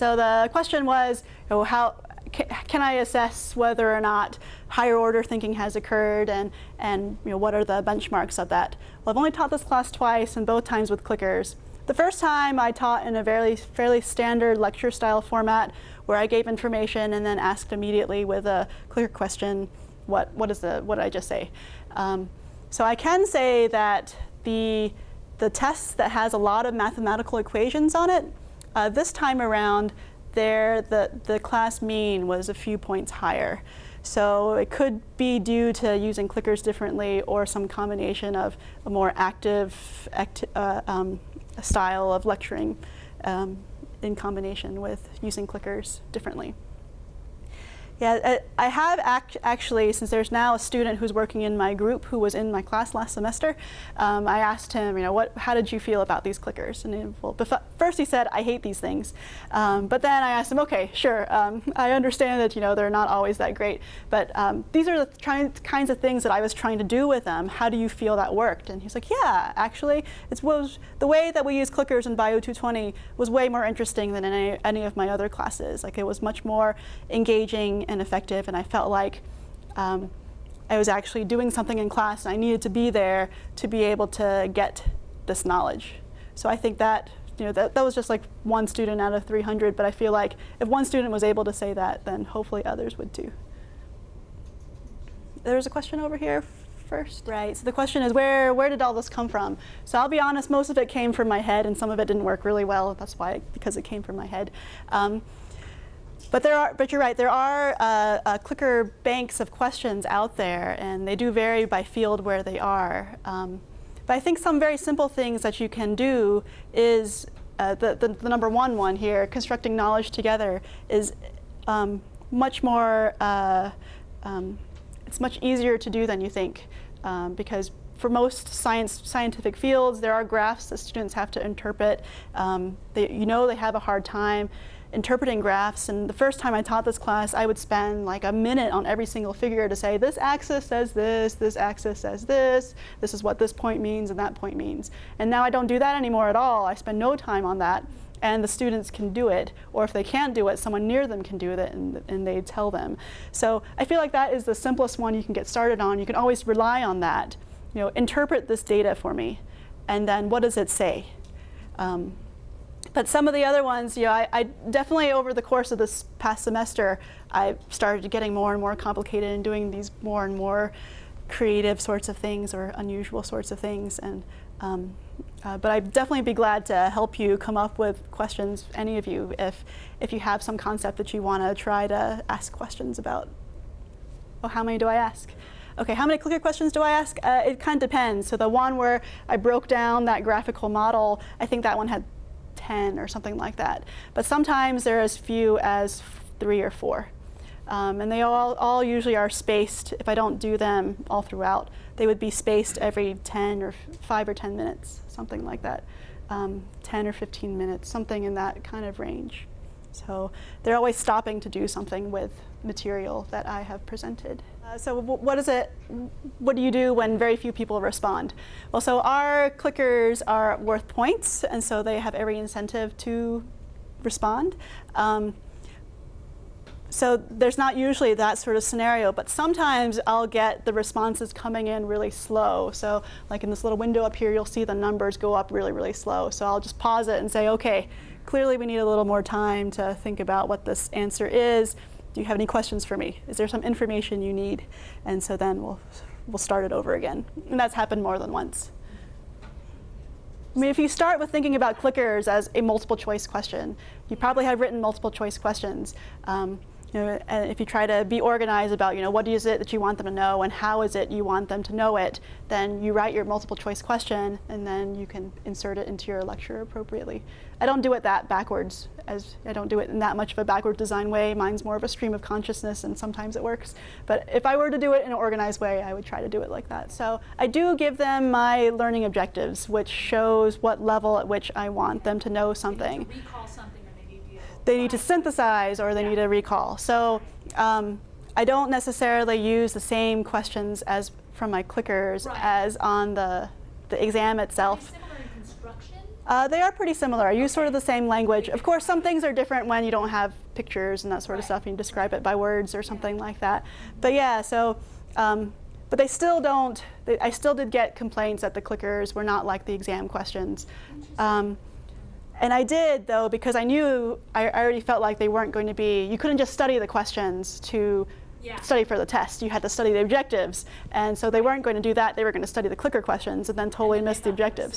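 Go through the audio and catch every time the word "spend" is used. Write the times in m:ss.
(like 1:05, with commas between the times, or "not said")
2:17, 2:26.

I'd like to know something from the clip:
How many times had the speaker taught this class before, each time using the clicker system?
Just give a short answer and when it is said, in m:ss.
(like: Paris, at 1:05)
2, at 0:09.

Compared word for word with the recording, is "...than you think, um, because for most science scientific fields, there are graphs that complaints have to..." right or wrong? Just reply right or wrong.
wrong.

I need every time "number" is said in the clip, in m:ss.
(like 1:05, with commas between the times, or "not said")
1:58, 3:54.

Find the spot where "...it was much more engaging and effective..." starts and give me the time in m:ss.
1:15.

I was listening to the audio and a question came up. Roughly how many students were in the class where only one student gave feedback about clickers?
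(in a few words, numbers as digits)
300.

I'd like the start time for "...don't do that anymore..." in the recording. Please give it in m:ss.
2:25.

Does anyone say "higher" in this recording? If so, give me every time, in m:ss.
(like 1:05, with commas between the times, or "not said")
0:04, 0:33.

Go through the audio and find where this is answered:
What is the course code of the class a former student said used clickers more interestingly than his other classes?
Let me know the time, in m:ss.
1:12.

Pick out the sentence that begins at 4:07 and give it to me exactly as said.
And that's happened more than once.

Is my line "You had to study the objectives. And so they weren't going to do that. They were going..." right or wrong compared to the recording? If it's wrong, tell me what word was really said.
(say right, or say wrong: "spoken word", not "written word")
right.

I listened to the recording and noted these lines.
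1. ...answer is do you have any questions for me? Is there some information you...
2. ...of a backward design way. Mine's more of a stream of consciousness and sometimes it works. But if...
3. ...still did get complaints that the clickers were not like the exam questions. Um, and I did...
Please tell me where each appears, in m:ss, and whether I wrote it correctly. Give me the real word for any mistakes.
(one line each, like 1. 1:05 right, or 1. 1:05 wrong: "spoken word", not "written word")
1. 4:00 right
2. 4:30 right
3. 5:07 right.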